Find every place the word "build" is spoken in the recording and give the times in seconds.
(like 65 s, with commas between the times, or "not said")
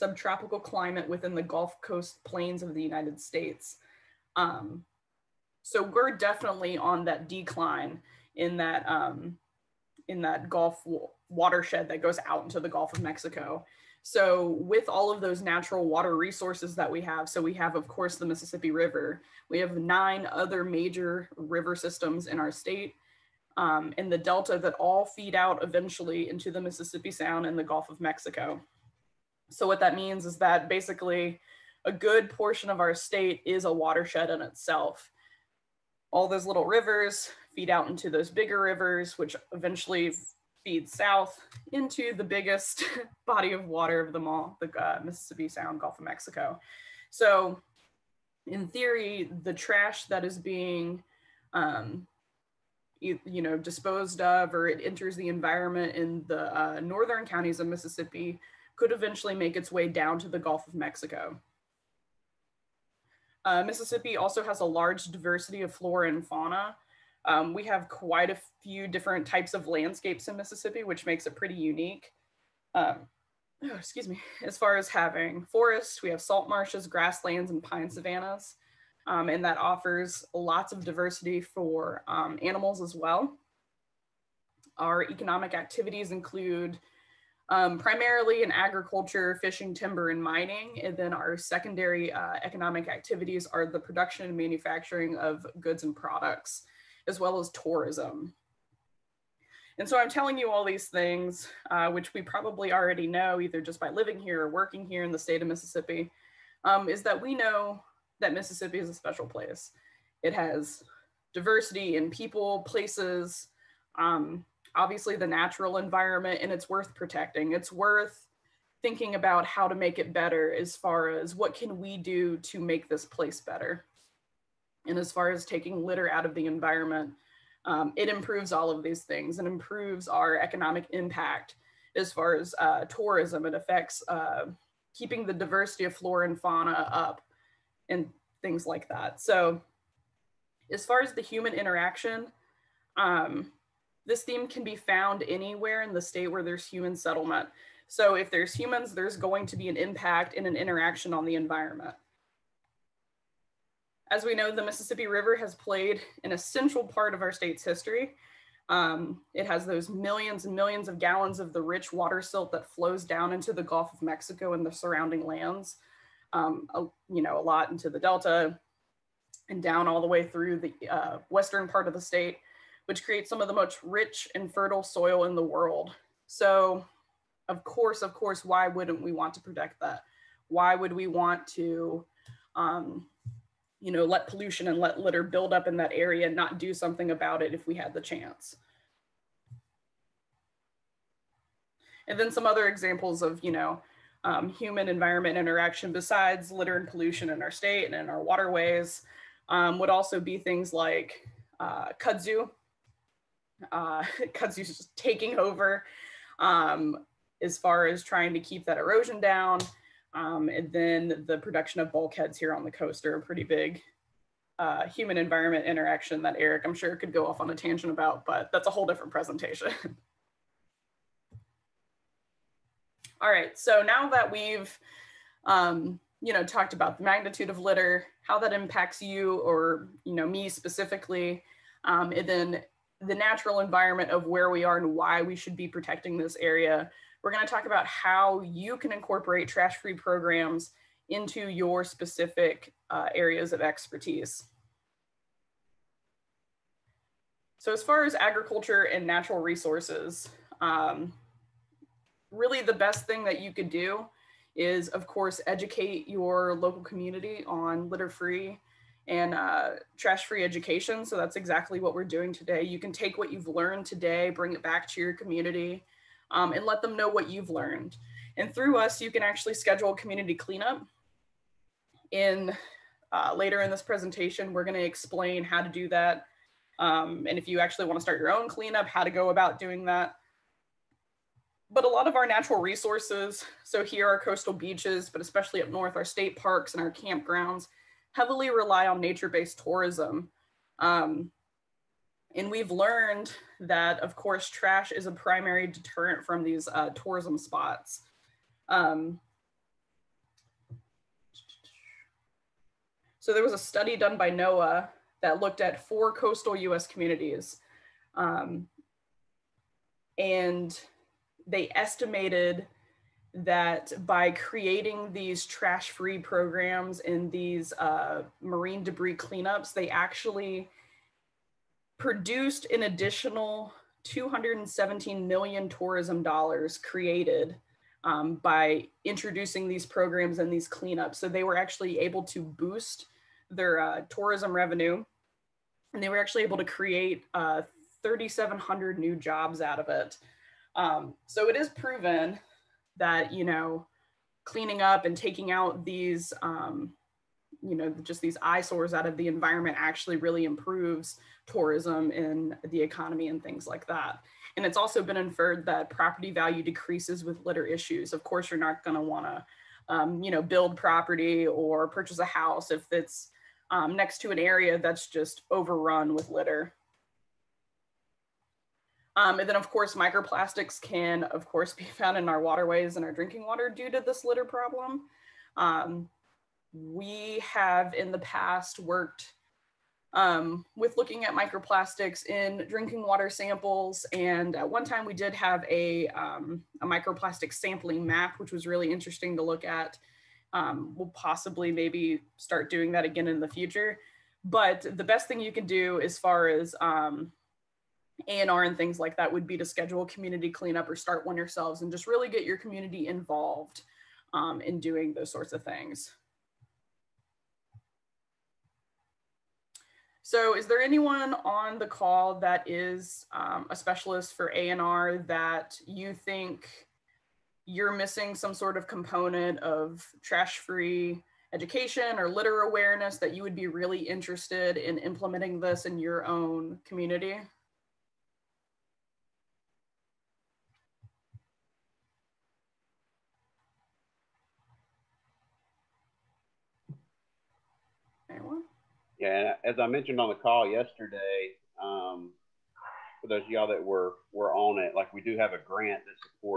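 185 s, 360 s.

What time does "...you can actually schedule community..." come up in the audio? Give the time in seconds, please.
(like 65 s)
269 s.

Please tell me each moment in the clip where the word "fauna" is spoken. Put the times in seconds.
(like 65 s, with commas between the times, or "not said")
66 s, 136 s.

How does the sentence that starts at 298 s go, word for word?
Um, so there was a study done by NOAA that looked at four coastal US communities.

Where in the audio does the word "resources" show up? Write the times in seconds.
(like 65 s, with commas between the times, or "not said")
16 s, 249 s, 282 s.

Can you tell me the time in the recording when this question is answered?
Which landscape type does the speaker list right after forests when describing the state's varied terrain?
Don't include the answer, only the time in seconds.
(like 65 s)
76 s.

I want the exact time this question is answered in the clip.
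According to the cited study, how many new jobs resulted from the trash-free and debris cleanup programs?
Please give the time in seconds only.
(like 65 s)
338 s.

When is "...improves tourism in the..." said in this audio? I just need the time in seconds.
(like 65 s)
350 s.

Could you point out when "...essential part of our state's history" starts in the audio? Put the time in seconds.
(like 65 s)
156 s.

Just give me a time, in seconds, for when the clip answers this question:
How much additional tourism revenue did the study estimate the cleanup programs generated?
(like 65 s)
324 s.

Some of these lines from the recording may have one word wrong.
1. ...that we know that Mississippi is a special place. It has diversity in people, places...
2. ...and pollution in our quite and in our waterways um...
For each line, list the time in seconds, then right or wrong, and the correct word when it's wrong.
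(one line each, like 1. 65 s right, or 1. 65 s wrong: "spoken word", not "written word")
1. 107 s right
2. 196 s wrong: "state", not "quite".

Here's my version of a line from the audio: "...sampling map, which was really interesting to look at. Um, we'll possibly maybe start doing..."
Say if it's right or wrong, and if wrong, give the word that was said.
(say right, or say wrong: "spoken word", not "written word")
right.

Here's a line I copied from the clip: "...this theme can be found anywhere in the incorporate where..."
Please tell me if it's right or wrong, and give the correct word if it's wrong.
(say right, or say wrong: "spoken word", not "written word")
wrong: "state", not "incorporate".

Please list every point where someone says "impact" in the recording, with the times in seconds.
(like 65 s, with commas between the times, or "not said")
130 s, 149 s, 228 s.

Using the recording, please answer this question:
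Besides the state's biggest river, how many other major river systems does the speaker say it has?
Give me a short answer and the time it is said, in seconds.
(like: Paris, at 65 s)
9, at 19 s.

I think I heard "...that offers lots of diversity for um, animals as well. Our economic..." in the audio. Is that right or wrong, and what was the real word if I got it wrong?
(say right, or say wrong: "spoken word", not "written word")
right.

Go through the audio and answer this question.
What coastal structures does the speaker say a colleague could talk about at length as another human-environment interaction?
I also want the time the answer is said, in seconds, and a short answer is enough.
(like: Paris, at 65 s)
Bulkheads, at 211 s.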